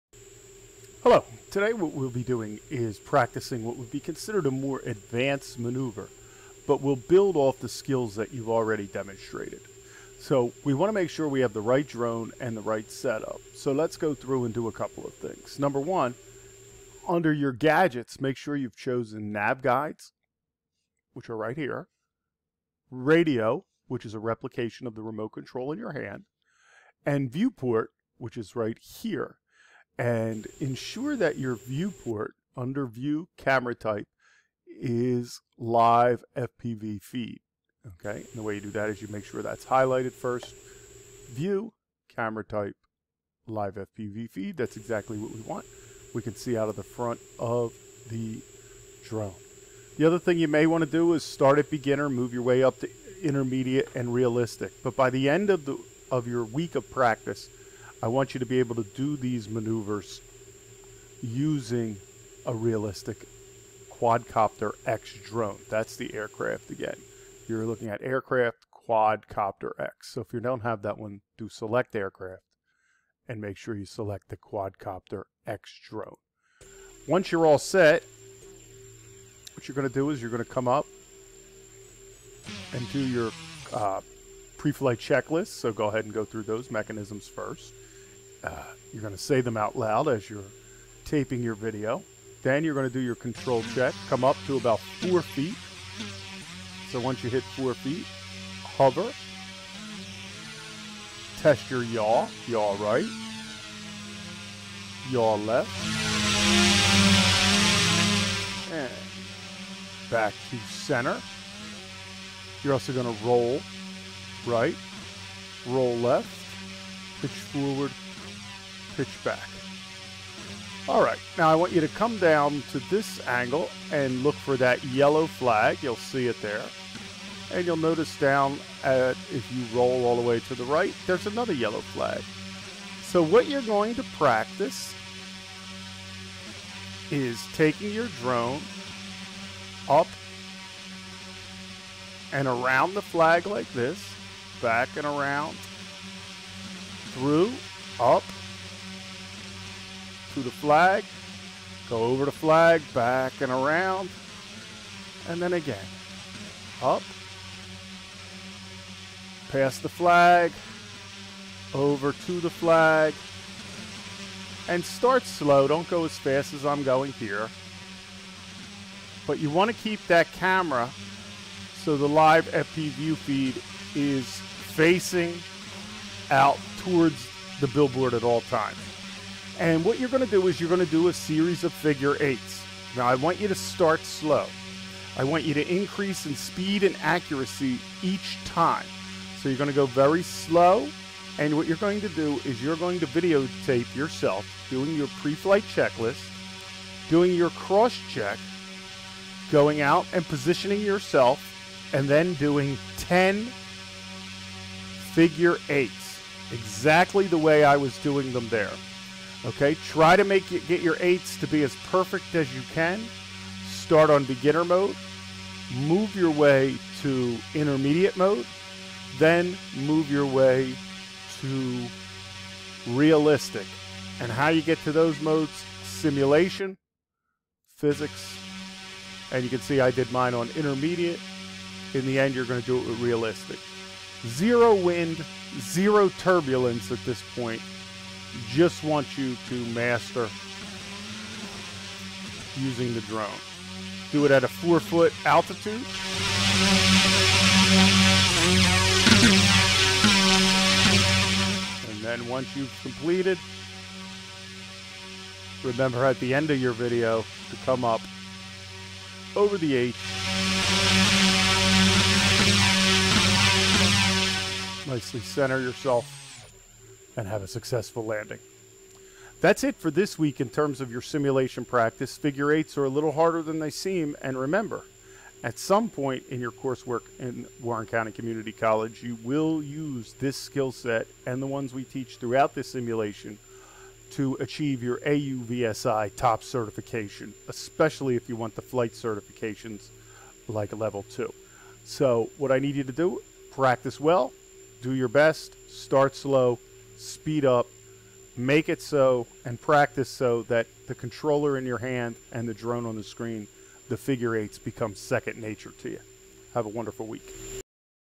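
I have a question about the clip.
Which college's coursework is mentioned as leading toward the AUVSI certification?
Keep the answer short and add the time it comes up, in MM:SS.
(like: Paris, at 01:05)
Warren County Community College, at 04:37.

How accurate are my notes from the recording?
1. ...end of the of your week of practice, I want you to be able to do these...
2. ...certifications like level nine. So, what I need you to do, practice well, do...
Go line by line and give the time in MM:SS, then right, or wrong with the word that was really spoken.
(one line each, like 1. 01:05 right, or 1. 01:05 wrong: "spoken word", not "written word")
1. 00:55 right
2. 04:48 wrong: "two", not "nine".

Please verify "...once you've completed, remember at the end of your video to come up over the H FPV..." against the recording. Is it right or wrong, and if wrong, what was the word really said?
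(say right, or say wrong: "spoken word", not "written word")
wrong: "Nicely", not "FPV".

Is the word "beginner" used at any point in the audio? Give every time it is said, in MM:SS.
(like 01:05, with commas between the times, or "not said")
00:51, 03:34.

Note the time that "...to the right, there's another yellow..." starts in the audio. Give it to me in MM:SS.
02:10.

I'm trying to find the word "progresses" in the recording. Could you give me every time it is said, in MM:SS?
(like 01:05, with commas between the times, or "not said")
not said.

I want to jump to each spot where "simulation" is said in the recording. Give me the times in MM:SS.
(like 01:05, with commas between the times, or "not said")
03:45, 04:31, 04:42.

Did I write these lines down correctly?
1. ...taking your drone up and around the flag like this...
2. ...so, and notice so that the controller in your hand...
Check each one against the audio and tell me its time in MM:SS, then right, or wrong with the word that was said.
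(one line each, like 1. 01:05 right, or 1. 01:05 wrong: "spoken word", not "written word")
1. 02:17 right
2. 04:58 wrong: "practice", not "notice".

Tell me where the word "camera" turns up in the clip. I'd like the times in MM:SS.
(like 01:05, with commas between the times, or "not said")
00:33, 00:42, 02:50.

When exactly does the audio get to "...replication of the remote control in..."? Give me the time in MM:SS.
00:24.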